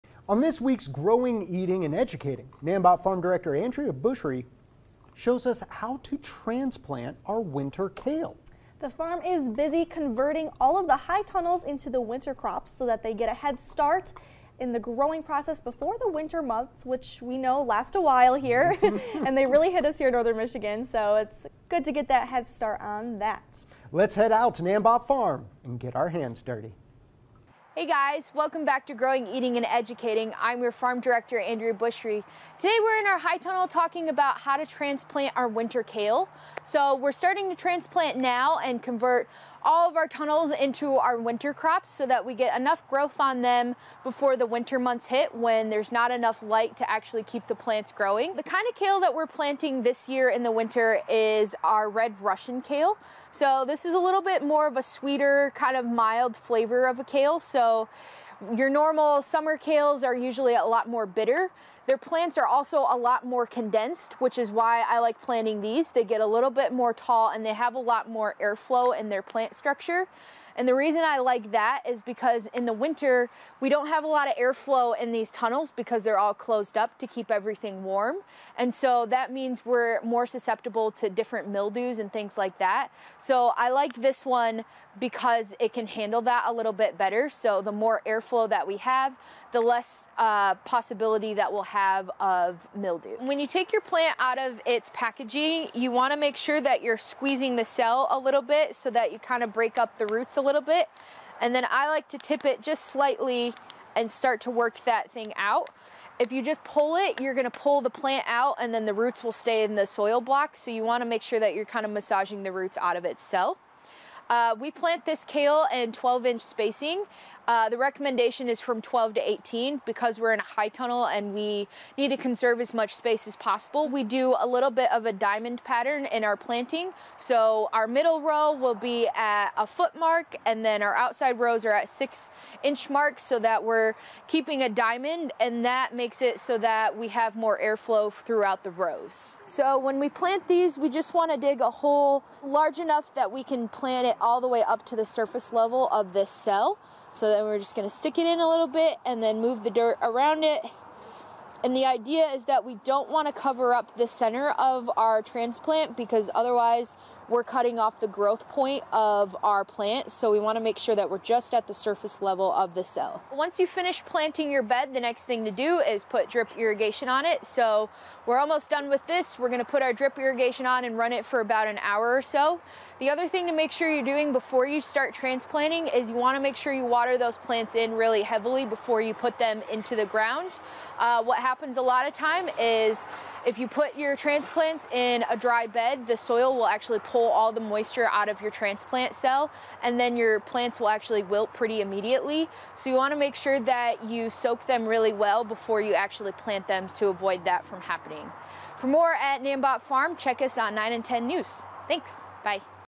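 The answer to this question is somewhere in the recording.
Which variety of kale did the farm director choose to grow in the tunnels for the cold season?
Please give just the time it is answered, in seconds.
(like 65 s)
51 s.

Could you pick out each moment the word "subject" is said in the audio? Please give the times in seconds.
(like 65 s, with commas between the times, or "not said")
not said.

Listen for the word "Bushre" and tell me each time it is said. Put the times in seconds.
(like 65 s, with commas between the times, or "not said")
3 s, 31 s.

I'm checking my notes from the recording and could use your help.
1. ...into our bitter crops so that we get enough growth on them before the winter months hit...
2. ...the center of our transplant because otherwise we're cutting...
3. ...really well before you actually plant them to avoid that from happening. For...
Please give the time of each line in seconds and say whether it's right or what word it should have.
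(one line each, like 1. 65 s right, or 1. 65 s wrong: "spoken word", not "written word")
1. 40 s wrong: "winter", not "bitter"
2. 153 s right
3. 194 s right.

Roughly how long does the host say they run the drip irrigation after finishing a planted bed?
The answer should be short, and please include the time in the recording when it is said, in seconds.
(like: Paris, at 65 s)
About an hour, at 171 s.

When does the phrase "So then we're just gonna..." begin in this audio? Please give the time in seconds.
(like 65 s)
147 s.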